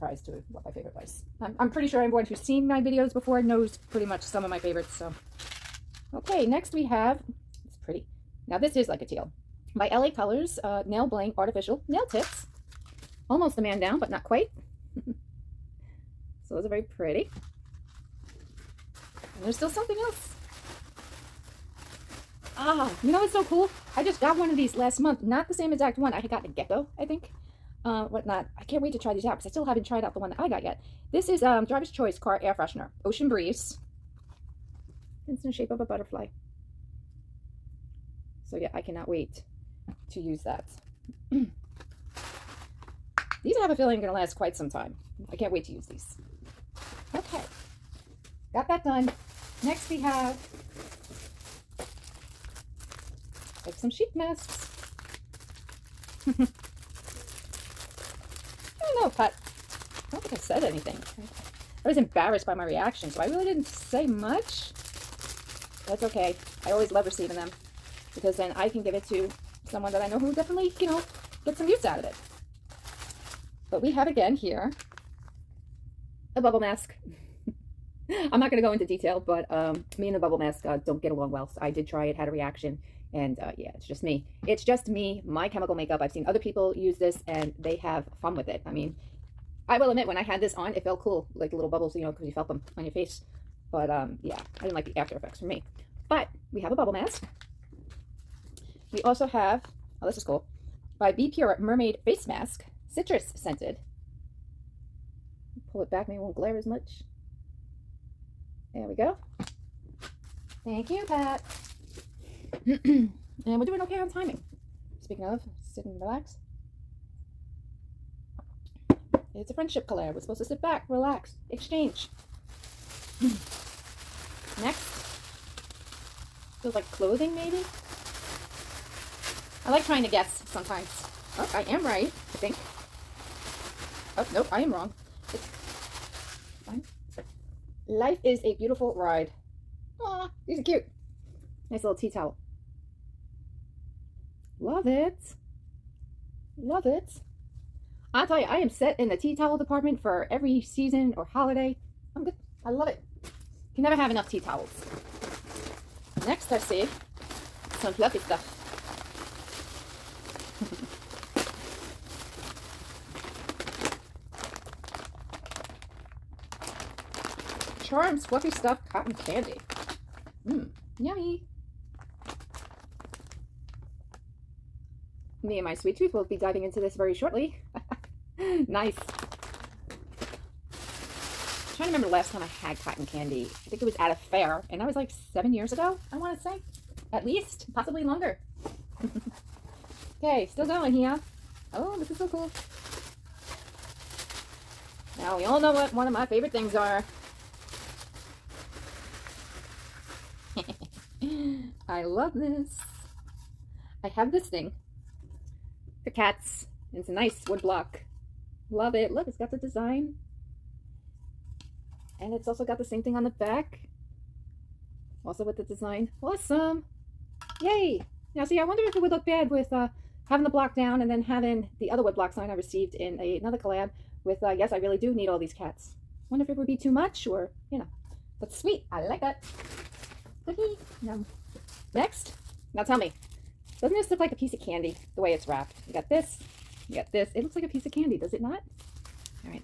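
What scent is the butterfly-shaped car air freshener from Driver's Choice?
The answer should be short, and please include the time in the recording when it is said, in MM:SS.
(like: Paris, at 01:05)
Ocean Breeze, at 00:33.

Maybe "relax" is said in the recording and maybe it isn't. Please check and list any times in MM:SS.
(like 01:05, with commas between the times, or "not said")
01:56, 02:00.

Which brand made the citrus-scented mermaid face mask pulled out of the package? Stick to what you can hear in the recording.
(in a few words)
Be Pure.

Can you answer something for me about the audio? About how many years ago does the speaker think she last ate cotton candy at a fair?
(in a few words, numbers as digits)
7.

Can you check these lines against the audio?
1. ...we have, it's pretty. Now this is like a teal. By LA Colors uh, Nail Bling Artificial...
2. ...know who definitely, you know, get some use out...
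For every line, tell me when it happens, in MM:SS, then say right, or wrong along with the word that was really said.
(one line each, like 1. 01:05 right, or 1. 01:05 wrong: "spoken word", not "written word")
1. 00:06 right
2. 01:10 right.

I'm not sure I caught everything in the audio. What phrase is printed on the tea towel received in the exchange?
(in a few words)
Life is a Beautiful Ride.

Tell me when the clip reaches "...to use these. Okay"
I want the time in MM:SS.
00:45.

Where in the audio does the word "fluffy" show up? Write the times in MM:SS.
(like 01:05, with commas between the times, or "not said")
02:37, 02:48.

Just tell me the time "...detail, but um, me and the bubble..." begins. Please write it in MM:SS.
01:18.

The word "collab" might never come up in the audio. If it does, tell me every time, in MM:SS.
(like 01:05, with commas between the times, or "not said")
01:59, 03:43.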